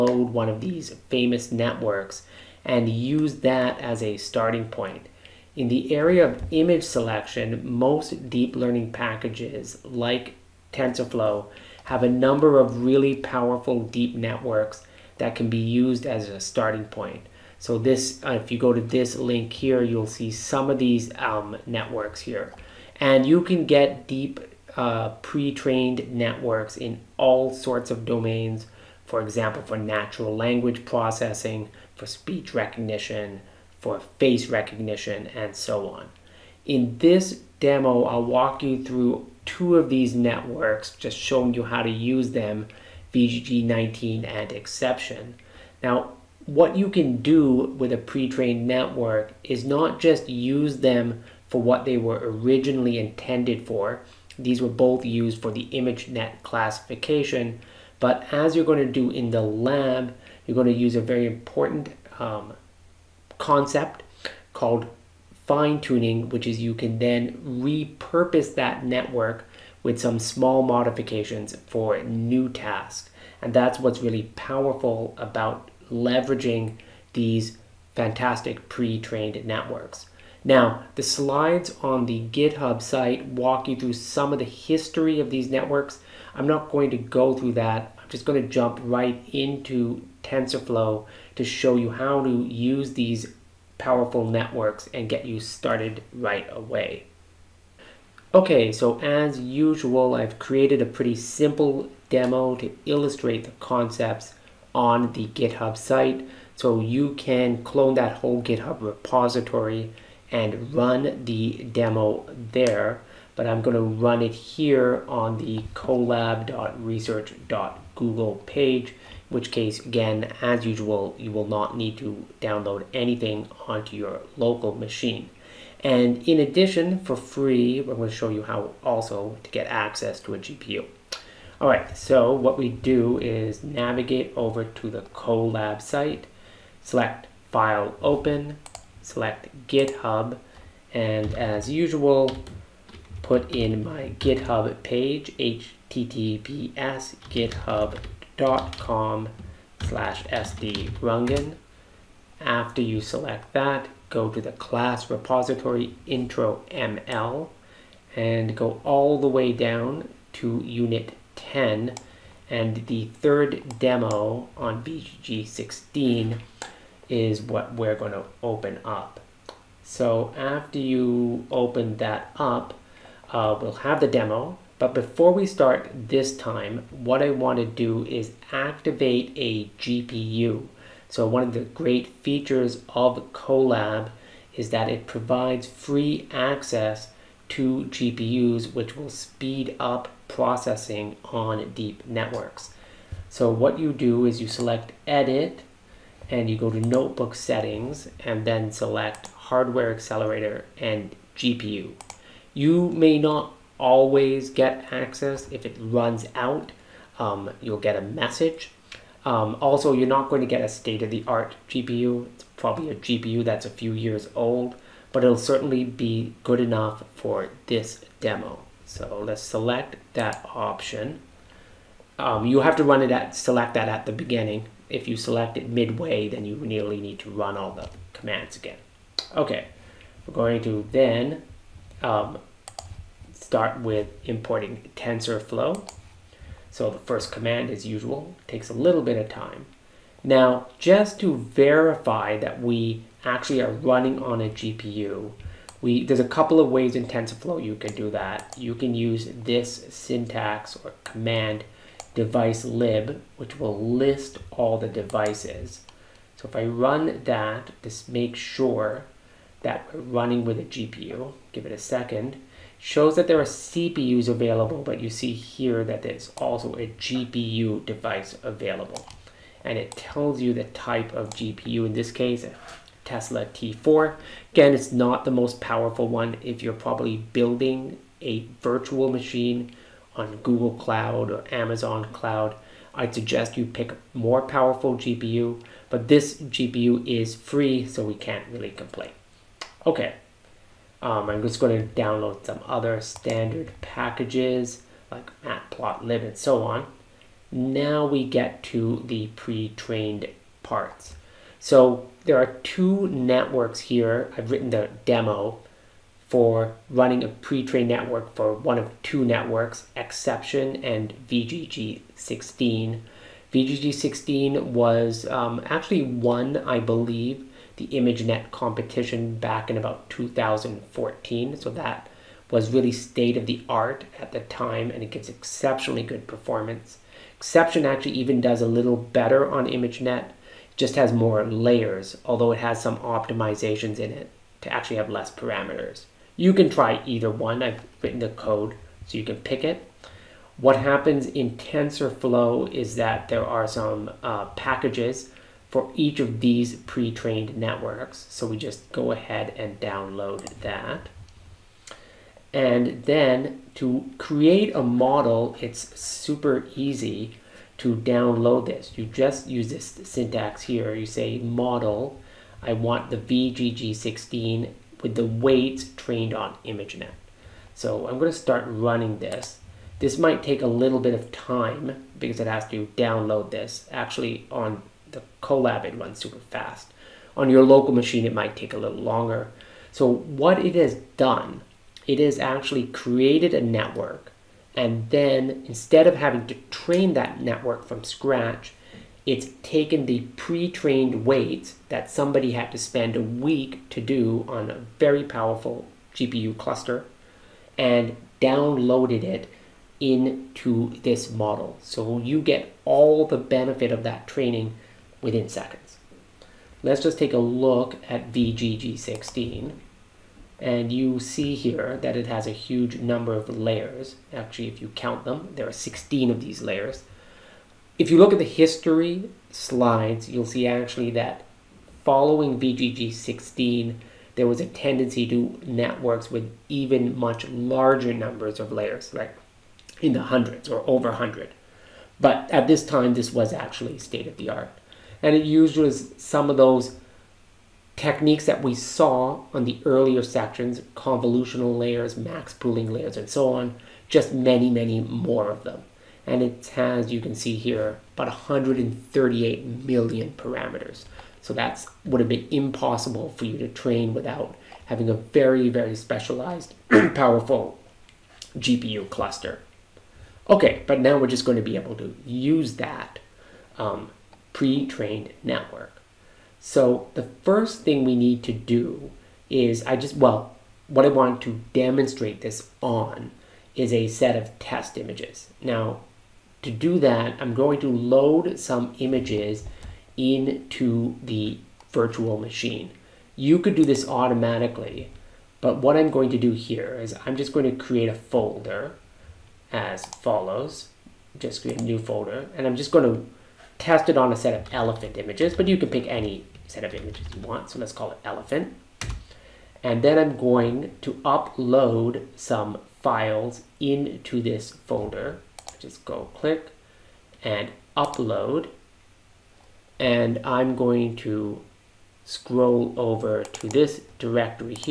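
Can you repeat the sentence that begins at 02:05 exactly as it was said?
And in addition, for free, I'm going to show you how also to get access to a GPU.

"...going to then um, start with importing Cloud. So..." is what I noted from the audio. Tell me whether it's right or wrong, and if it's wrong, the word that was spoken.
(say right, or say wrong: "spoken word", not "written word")
wrong: "TensorFlow", not "Cloud".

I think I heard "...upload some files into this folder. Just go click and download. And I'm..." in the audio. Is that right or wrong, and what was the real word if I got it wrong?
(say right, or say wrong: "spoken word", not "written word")
wrong: "upload", not "download".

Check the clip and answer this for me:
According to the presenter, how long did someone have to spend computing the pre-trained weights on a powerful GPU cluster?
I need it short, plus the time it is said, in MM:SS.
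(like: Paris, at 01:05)
a week, at 06:33.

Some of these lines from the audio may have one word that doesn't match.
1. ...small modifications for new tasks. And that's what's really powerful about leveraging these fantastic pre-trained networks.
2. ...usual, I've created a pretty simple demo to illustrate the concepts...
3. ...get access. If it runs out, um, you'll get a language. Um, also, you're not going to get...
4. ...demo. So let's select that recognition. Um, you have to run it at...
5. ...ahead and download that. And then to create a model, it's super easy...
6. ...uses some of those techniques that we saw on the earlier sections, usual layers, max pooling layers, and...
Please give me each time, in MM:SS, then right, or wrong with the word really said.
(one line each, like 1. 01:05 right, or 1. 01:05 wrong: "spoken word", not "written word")
1. 01:10 right
2. 01:39 right
3. 03:24 wrong: "message", not "language"
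4. 03:38 wrong: "option", not "recognition"
5. 05:49 right
6. 07:15 wrong: "convolutional", not "usual".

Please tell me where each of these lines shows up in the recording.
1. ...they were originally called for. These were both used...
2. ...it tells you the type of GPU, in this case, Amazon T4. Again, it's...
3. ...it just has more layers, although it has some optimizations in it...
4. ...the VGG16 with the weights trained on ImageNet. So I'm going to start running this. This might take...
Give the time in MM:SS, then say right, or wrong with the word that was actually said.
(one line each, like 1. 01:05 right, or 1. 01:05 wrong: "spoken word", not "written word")
1. 00:51 wrong: "intended", not "called"
2. 04:29 wrong: "Tesla", not "Amazon"
3. 05:30 right
4. 06:03 right.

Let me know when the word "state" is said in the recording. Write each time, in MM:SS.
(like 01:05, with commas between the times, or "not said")
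03:30, 05:22, 07:13.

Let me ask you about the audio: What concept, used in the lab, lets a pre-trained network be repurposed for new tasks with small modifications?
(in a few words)
fine tuning.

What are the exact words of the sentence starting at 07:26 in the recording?
And it has, you can see here, about 138 million parameters.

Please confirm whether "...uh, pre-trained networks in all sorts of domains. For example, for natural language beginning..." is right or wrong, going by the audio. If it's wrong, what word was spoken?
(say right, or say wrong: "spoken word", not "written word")
wrong: "processing", not "beginning".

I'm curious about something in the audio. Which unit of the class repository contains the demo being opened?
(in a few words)
unit 10.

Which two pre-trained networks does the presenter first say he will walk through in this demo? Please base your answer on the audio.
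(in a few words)
VGG19 and Xception.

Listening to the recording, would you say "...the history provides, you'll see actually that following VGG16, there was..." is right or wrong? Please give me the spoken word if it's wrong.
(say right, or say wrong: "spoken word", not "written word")
wrong: "slides", not "provides".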